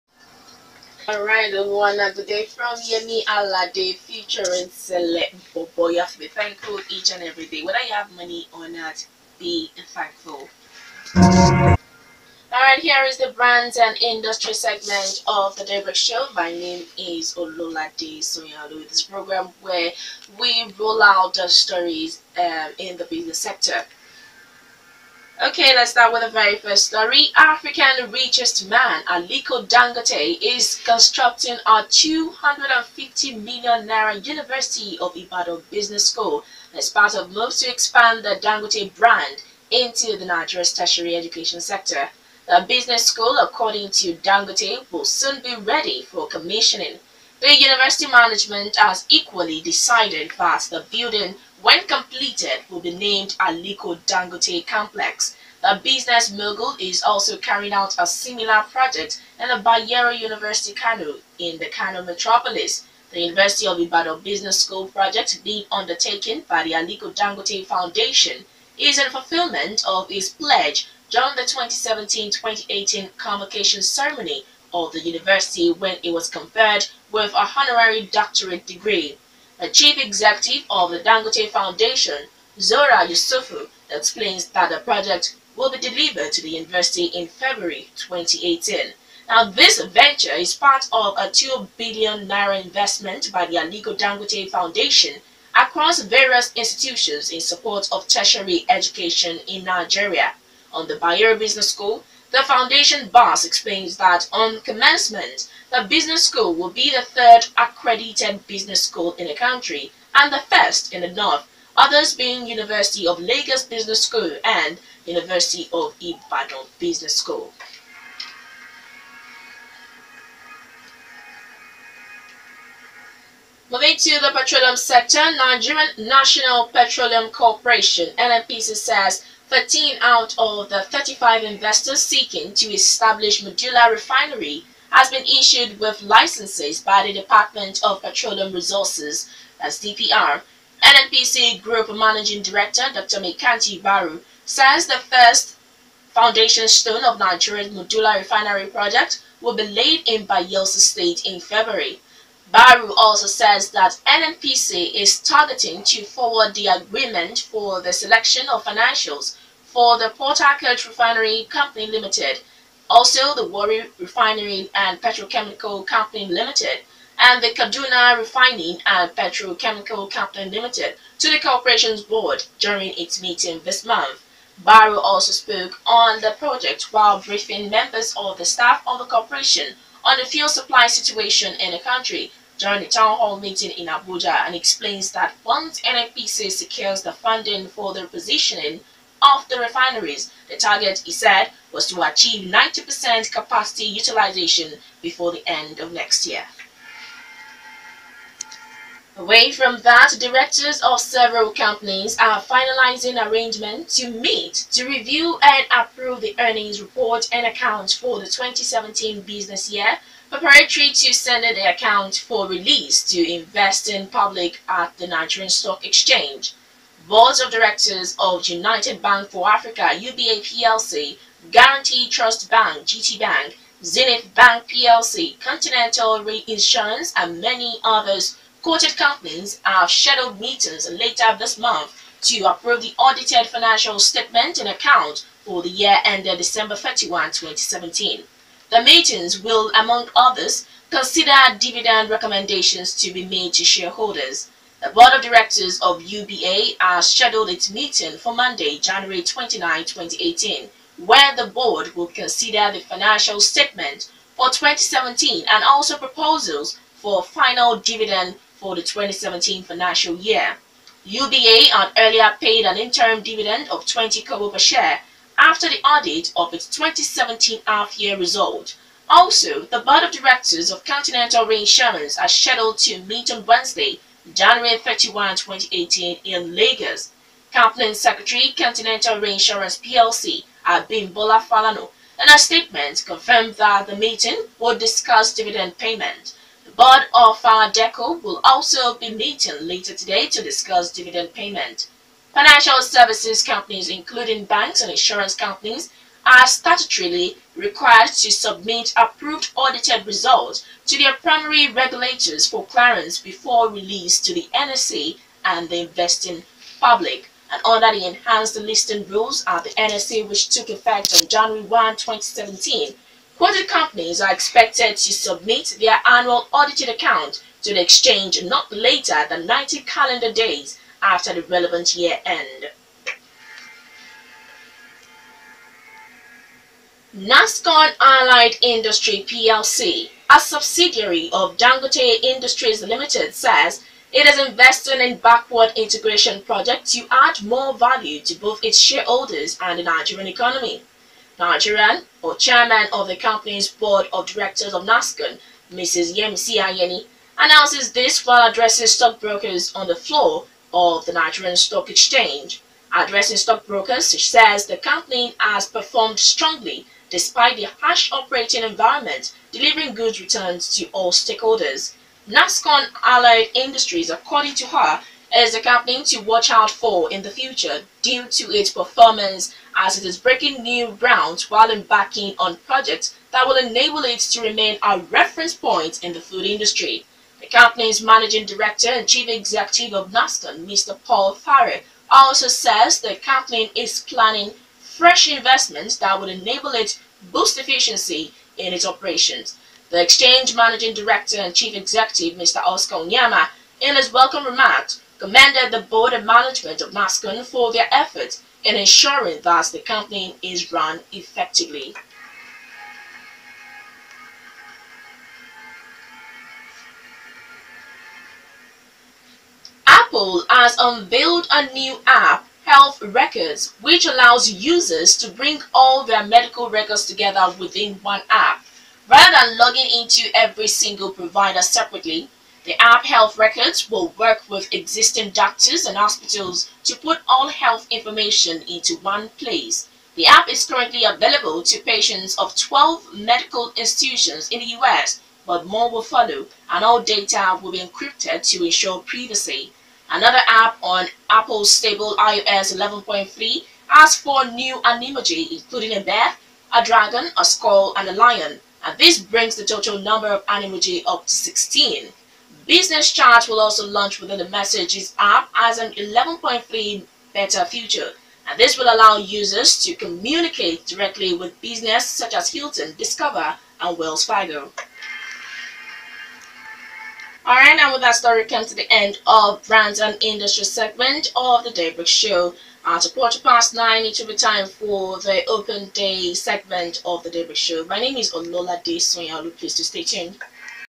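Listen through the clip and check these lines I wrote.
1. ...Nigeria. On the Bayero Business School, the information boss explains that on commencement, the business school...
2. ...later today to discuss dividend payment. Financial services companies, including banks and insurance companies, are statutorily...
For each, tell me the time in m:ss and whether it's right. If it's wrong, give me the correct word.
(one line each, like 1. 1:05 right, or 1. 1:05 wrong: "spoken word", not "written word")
1. 1:39 wrong: "foundation", not "information"
2. 4:49 right.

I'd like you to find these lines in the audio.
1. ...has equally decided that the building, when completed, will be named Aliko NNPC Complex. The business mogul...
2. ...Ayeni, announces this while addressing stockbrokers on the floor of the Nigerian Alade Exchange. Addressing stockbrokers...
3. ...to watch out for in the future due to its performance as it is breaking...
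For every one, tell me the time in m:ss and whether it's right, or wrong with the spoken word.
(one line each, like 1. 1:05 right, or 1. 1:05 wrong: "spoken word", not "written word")
1. 0:48 wrong: "Dangote", not "NNPC"
2. 5:46 wrong: "Stock", not "Alade"
3. 6:06 right.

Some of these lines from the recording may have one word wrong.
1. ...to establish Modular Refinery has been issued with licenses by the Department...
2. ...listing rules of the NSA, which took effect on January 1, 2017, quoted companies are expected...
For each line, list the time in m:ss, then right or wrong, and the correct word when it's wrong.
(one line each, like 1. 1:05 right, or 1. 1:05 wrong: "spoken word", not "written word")
1. 2:12 right
2. 5:08 right.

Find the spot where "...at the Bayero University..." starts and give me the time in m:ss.
0:59.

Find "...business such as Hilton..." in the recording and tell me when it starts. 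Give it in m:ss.
7:41.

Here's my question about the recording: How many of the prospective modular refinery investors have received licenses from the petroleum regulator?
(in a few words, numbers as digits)
13.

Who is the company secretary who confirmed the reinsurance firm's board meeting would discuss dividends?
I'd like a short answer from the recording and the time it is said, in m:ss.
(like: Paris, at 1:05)
Abimbola Falano, at 4:40.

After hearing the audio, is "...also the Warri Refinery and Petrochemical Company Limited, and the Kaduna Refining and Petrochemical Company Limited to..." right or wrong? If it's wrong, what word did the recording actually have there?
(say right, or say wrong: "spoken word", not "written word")
right.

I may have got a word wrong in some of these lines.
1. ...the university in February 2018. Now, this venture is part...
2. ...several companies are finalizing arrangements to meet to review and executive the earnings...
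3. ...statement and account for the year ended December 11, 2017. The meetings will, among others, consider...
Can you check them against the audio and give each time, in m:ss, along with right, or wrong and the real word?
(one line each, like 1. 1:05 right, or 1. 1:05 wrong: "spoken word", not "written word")
1. 1:26 right
2. 3:21 wrong: "approve", not "executive"
3. 3:53 wrong: "31", not "11".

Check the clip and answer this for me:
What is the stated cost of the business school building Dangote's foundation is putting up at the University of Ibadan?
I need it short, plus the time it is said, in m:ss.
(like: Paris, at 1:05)
250 million naira, at 0:31.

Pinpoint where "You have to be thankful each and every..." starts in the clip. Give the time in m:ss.
0:05.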